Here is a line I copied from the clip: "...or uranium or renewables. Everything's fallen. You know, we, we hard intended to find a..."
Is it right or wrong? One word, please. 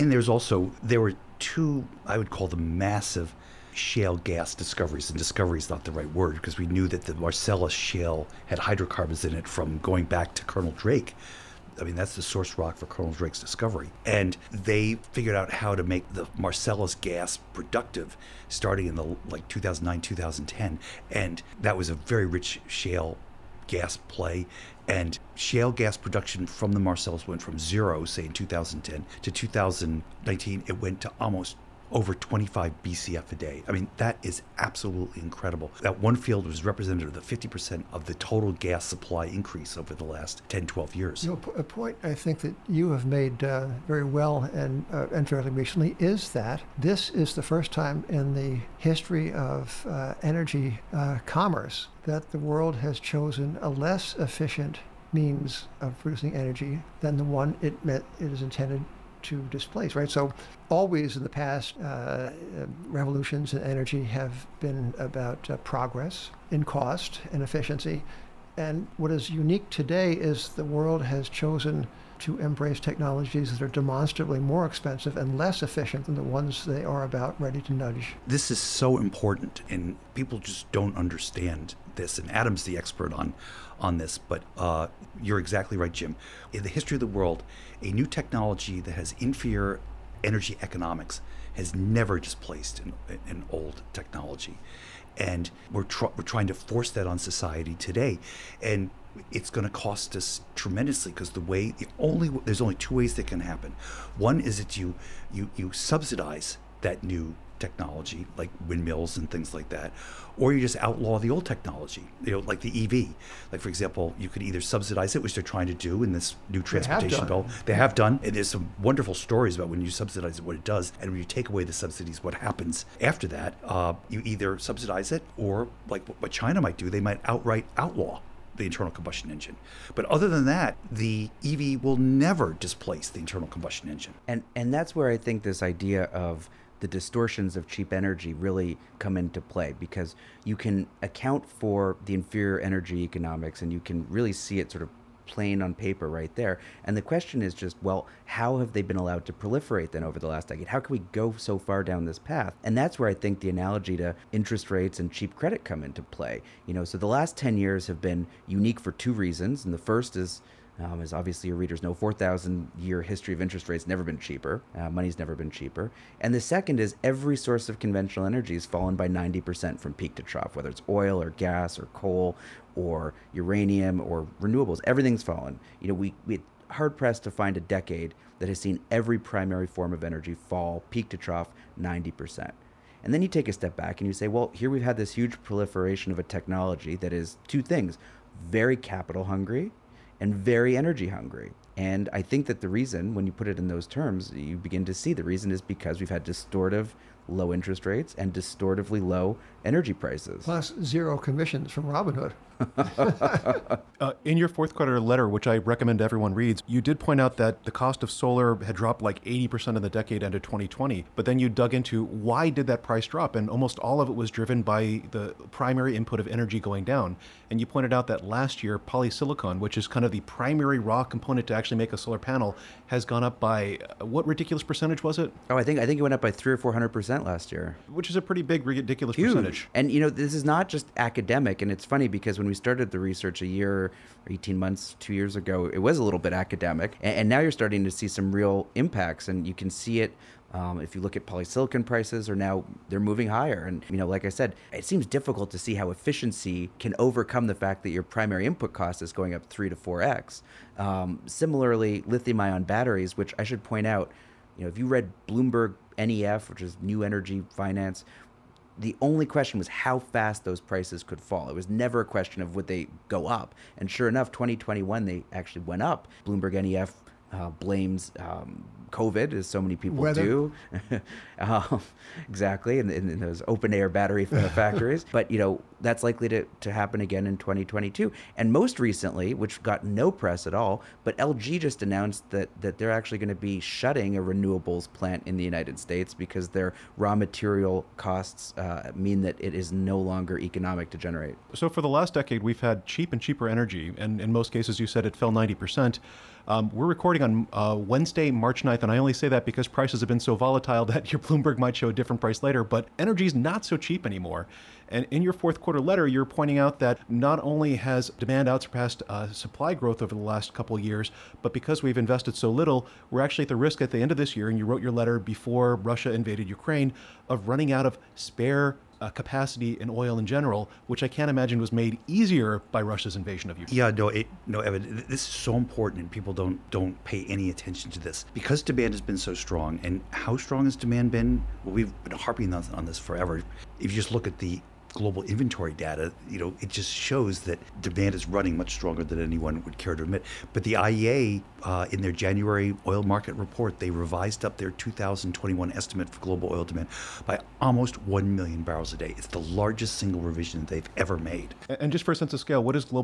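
wrong.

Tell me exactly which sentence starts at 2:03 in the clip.
Uh, you either subsidize it, or like what China might do, they might outright outlaw the internal combustion engine.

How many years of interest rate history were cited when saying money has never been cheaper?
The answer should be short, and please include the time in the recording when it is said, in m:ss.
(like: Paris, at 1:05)
4,000, at 2:41.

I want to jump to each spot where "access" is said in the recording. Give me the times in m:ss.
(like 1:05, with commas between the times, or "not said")
not said.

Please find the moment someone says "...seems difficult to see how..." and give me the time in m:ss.
4:04.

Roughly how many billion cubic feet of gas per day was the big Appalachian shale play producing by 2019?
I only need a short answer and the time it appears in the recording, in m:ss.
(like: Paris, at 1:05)
25, at 0:32.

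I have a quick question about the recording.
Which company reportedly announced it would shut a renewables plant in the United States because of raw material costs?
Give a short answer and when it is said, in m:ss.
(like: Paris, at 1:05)
LG, at 4:41.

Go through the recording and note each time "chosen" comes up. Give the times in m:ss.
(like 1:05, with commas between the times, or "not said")
0:52, 1:11.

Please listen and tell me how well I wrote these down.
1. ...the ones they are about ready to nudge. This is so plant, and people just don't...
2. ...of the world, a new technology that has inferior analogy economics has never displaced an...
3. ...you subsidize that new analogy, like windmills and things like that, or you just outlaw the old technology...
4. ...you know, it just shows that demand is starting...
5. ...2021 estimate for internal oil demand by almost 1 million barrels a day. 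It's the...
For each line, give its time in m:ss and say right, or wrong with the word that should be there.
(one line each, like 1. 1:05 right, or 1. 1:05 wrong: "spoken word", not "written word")
1. 1:16 wrong: "important", not "plant"
2. 1:26 wrong: "energy", not "analogy"
3. 1:45 wrong: "technology", not "analogy"
4. 5:36 wrong: "running", not "starting"
5. 5:44 wrong: "global", not "internal".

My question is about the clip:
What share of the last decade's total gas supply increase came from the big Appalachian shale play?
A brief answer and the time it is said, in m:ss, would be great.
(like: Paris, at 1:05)
50%, at 0:37.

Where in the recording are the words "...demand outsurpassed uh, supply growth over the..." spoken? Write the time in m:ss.
5:08.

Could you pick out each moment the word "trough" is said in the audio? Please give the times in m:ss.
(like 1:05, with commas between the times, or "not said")
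2:50, 3:01.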